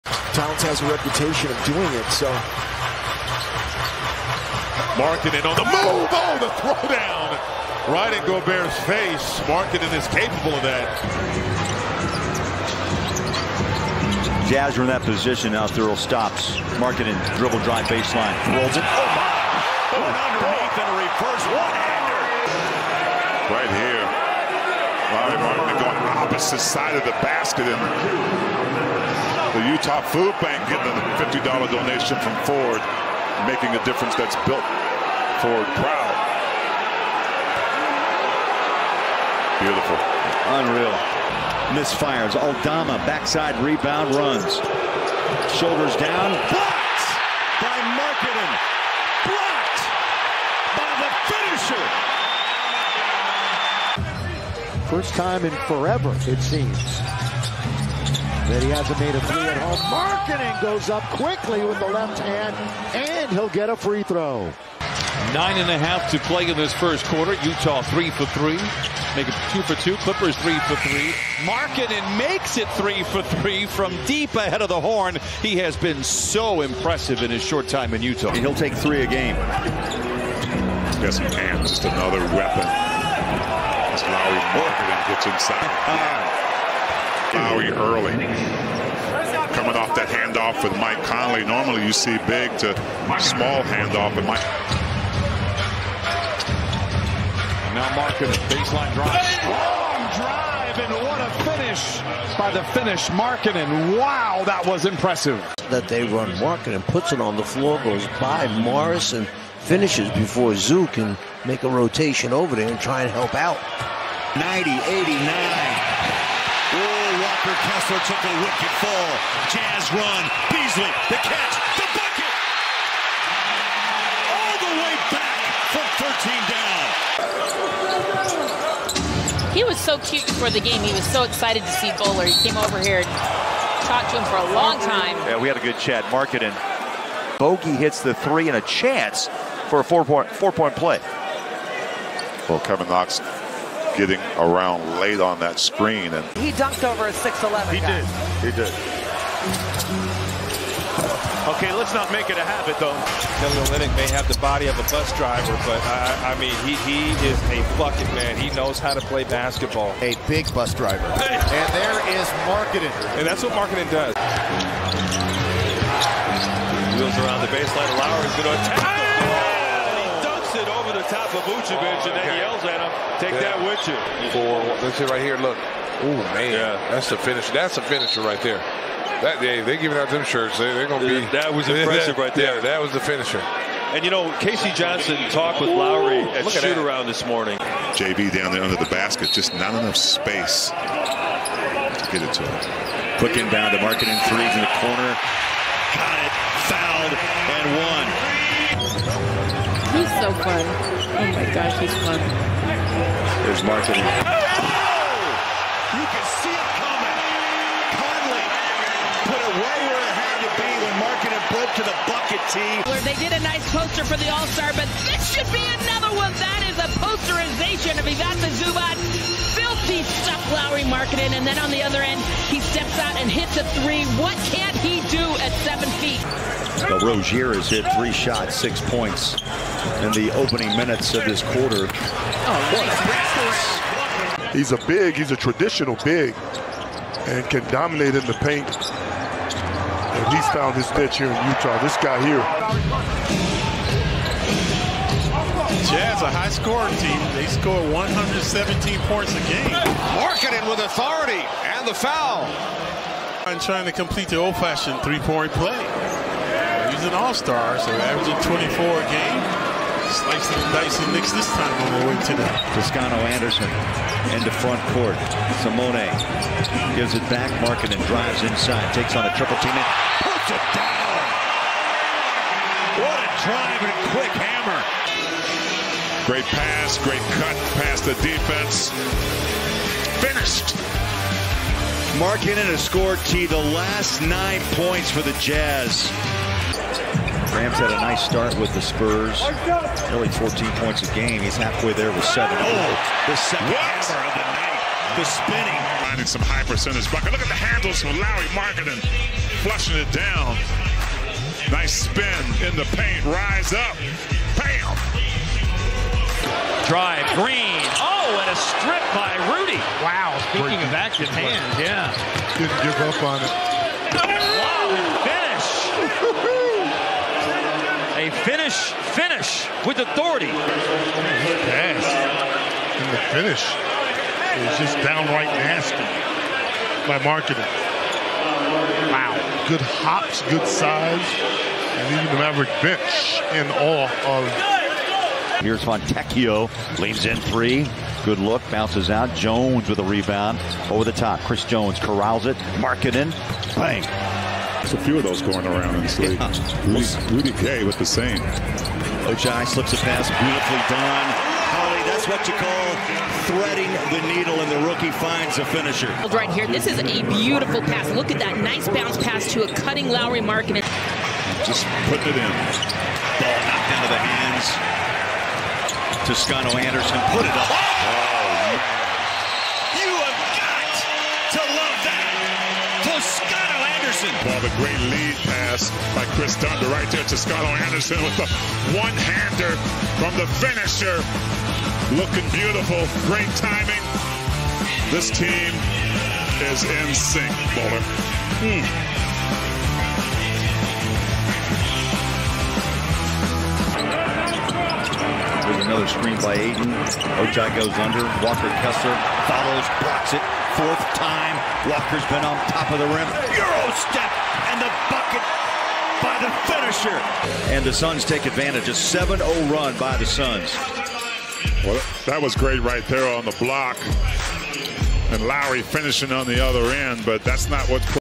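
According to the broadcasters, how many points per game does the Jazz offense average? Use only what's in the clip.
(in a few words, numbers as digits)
117.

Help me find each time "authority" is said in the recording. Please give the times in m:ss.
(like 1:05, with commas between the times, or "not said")
4:10, 5:19.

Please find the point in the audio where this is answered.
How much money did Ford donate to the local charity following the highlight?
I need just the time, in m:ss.
0:31.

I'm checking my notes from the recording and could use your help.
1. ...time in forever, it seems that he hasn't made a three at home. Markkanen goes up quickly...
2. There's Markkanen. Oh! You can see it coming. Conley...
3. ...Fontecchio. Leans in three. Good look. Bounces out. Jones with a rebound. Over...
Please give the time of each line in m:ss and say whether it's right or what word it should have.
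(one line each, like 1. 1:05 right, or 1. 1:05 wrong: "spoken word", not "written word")
1. 0:55 right
2. 3:23 right
3. 5:35 right.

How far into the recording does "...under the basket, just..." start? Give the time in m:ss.
3:08.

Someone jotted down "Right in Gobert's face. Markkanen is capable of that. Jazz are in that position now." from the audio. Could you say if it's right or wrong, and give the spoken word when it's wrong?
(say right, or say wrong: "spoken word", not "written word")
right.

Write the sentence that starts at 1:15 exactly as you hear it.
He has been so impressive in his short time in Utah.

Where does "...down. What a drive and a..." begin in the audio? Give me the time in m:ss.
4:30.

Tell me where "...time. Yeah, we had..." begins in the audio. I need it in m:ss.
2:14.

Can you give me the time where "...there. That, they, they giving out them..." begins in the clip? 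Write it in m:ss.
2:58.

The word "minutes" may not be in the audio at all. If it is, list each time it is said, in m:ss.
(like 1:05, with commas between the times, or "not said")
3:50.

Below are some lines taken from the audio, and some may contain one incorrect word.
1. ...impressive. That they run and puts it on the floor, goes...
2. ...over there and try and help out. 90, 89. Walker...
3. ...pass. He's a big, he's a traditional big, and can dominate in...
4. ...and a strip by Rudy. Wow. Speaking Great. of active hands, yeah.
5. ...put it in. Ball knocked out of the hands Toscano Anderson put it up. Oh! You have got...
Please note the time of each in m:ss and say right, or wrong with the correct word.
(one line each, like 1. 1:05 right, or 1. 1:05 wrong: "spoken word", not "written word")
1. 1:44 right
2. 1:52 right
3. 3:54 right
4. 5:08 right
5. 6:02 right.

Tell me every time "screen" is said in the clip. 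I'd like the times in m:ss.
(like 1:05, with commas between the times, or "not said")
2:25, 6:36.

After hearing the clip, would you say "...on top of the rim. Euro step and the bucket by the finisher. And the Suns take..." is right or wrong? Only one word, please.
right.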